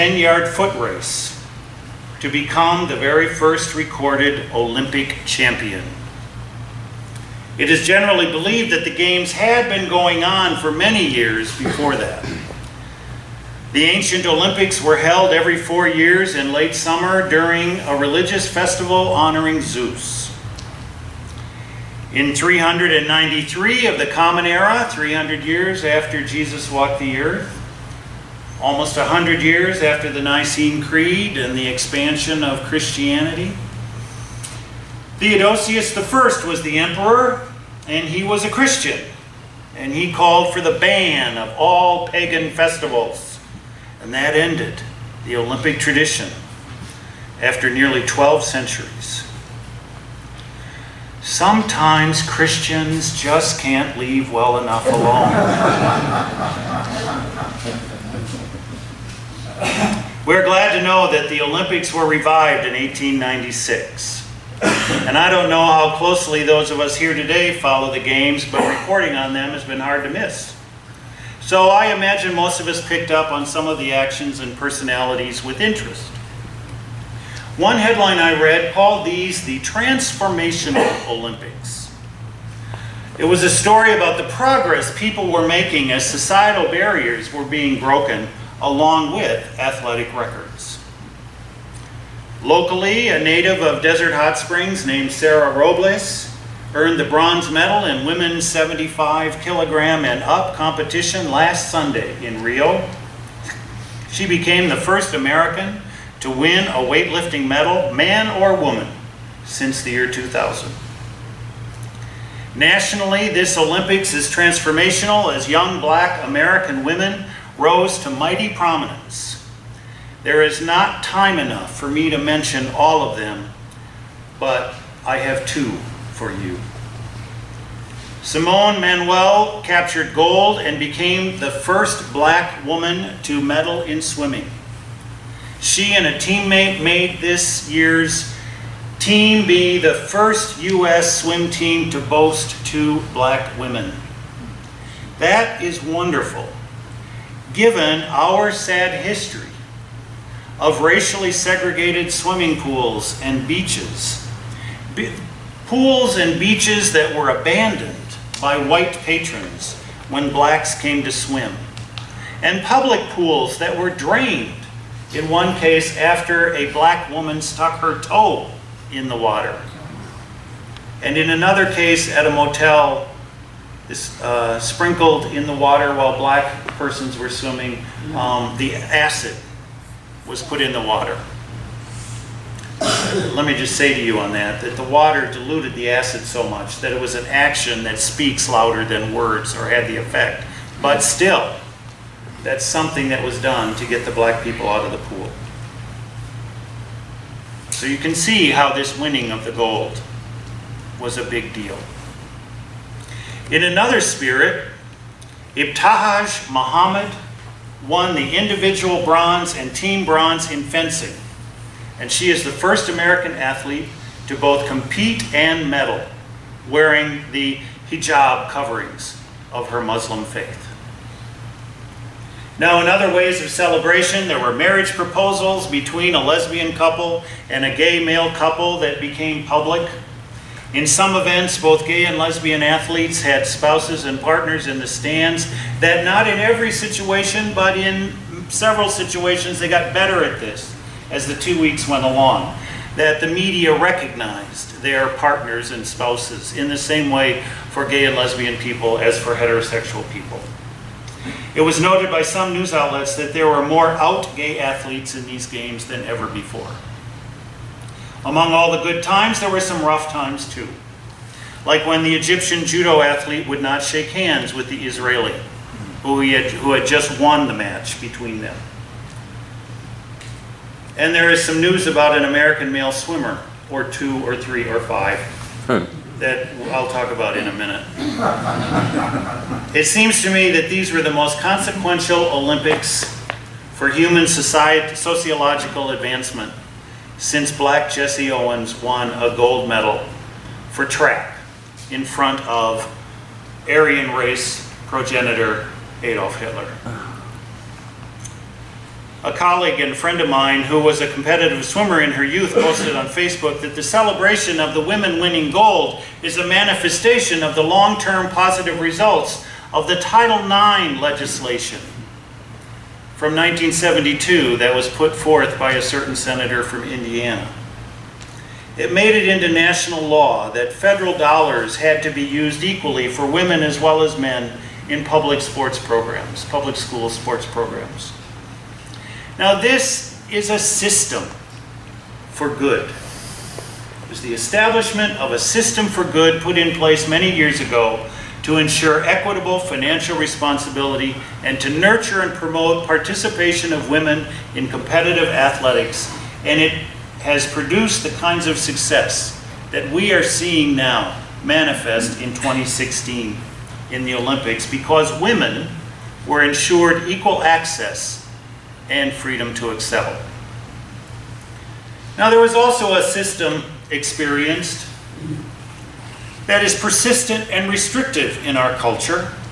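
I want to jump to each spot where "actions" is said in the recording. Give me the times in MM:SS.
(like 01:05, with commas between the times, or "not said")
01:13, 03:07.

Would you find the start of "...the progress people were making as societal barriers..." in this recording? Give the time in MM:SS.
01:24.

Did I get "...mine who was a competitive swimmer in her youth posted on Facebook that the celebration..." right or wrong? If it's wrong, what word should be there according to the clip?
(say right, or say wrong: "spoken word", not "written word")
right.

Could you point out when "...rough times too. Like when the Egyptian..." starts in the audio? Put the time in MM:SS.
04:19.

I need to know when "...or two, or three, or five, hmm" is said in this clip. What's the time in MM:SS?
04:33.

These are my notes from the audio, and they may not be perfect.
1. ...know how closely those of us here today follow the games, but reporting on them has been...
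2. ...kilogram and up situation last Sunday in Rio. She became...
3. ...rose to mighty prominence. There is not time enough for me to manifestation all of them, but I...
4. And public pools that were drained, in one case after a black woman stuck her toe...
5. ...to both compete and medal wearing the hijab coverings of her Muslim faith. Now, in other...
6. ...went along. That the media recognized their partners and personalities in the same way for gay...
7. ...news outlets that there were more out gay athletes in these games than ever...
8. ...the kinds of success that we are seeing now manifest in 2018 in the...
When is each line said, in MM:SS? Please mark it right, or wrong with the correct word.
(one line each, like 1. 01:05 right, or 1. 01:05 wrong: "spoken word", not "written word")
1. 01:05 right
2. 01:39 wrong: "competition", not "situation"
3. 01:57 wrong: "mention", not "manifestation"
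4. 02:42 right
5. 03:34 right
6. 04:01 wrong: "spouses", not "personalities"
7. 04:12 right
8. 05:48 wrong: "2016", not "2018".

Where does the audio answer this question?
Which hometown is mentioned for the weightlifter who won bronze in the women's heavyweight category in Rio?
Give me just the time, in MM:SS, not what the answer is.
01:33.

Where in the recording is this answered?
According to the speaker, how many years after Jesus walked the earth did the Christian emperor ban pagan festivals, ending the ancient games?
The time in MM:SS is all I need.
00:24.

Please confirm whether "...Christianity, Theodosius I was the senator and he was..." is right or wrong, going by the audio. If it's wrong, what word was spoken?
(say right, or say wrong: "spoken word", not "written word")
wrong: "emperor", not "senator".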